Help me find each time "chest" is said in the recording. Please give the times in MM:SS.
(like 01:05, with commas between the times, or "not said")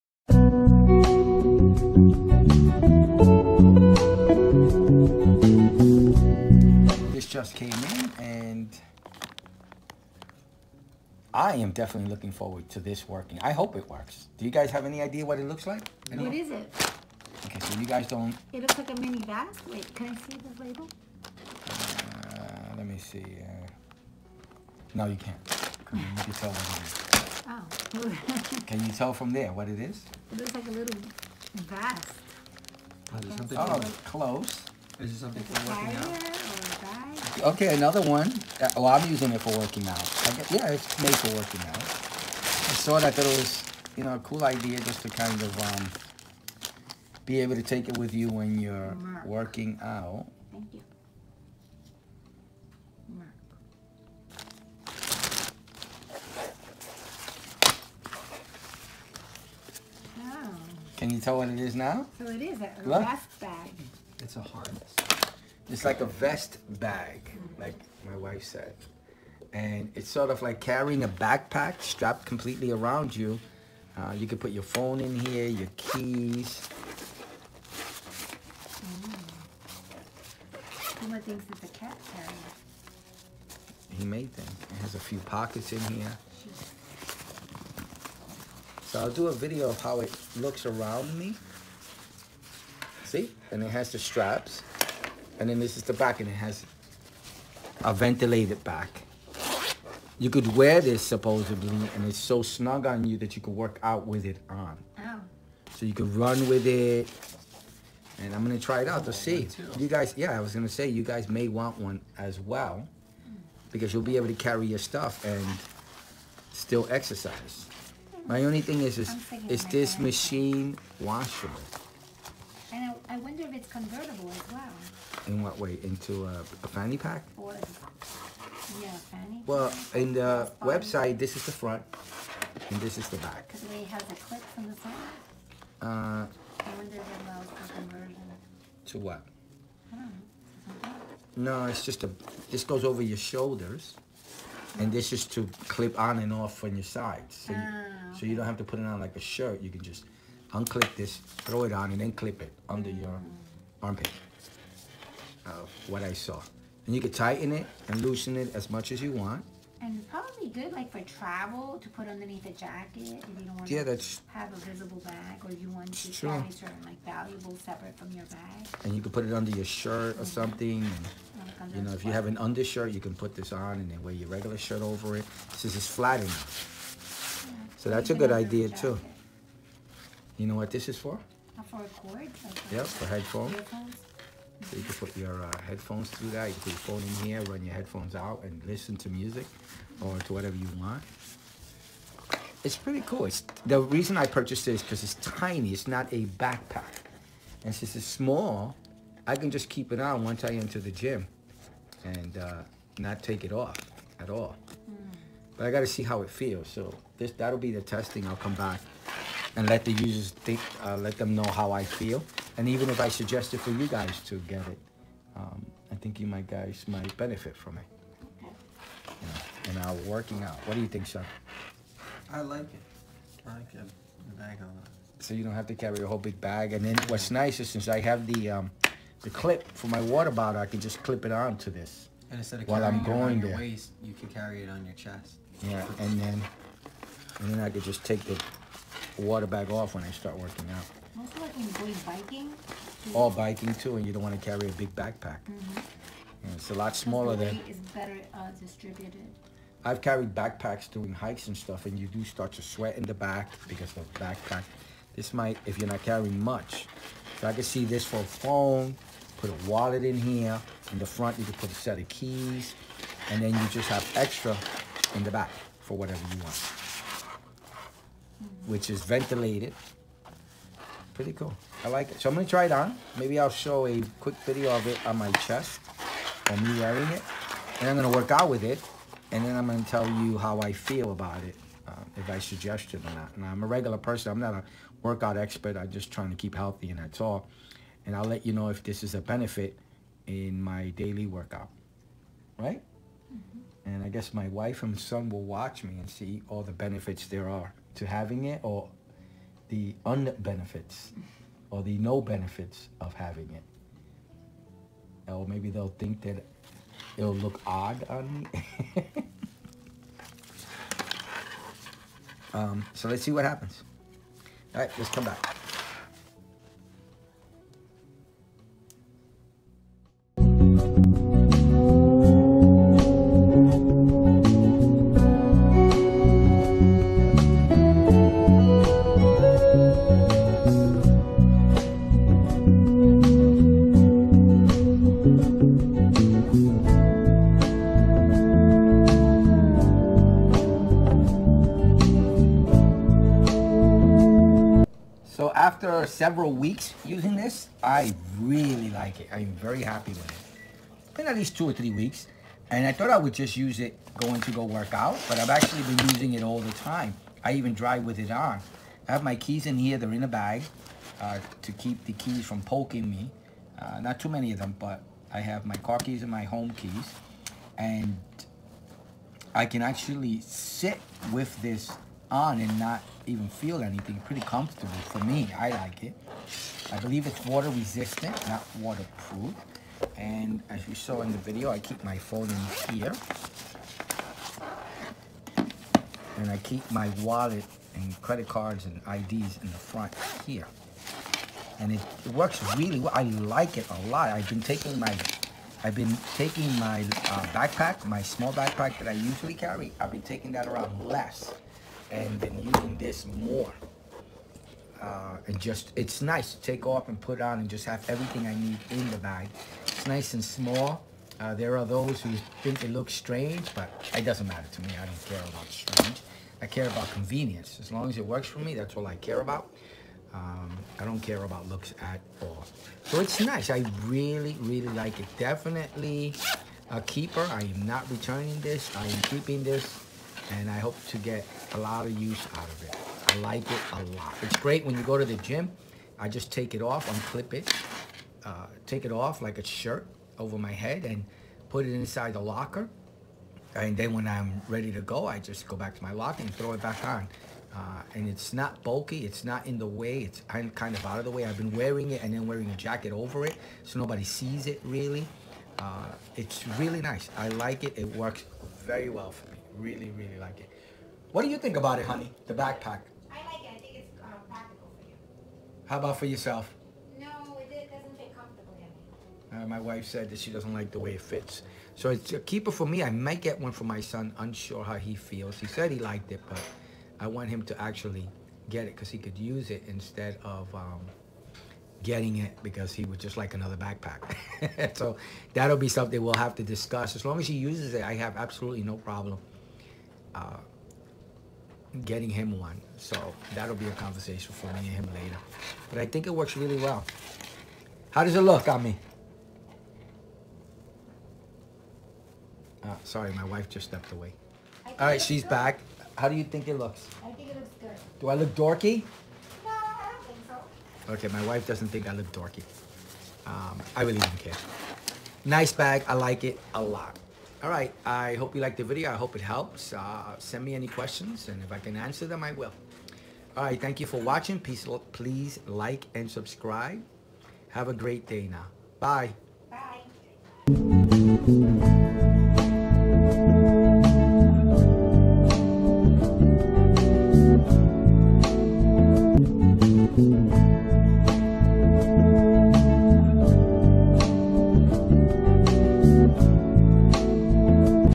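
03:54, 04:35.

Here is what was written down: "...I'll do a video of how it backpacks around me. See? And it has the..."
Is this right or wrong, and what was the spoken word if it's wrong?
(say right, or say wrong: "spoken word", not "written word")
wrong: "looks", not "backpacks".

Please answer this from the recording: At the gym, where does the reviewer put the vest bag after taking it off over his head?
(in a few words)
Inside the locker.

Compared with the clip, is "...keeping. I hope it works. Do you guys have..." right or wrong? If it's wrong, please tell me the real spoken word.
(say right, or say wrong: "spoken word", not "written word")
wrong: "working", not "keeping".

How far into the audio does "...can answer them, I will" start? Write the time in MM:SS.
08:41.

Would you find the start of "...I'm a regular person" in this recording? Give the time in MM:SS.
04:43.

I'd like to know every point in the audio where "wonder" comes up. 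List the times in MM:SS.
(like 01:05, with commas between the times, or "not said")
02:03, 02:16.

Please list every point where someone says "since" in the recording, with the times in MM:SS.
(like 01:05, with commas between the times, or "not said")
02:55, 03:17, 03:47.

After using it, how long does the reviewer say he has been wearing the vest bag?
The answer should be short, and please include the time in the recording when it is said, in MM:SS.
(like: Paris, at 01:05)
2 or 3 weeks, at 05:51.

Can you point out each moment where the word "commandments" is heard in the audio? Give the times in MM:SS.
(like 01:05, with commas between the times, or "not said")
not said.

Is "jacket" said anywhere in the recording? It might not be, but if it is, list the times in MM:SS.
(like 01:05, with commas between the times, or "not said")
02:42, 07:32.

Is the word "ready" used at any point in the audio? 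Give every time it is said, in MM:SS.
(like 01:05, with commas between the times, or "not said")
07:24.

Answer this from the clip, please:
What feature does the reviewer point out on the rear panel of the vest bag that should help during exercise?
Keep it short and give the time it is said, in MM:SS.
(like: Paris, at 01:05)
Ventilated back, at 01:37.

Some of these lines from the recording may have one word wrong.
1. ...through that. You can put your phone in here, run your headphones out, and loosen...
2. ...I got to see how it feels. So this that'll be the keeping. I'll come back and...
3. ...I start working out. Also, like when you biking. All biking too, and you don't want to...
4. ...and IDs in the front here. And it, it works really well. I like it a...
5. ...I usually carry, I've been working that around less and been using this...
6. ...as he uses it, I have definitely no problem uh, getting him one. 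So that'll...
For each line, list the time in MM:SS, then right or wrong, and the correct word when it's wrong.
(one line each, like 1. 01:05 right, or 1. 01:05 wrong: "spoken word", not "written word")
1. 03:06 wrong: "listen", not "loosen"
2. 03:25 wrong: "testing", not "keeping"
3. 04:00 right
4. 06:28 right
5. 06:39 wrong: "taking", not "working"
6. 08:07 wrong: "absolutely", not "definitely".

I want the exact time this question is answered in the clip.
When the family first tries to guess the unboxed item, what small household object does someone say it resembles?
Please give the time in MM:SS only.
00:18.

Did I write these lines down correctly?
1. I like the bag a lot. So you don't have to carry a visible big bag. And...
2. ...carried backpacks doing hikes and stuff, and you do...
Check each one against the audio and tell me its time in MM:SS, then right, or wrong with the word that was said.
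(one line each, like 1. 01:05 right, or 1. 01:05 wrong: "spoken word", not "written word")
1. 03:43 wrong: "whole", not "visible"
2. 04:09 right.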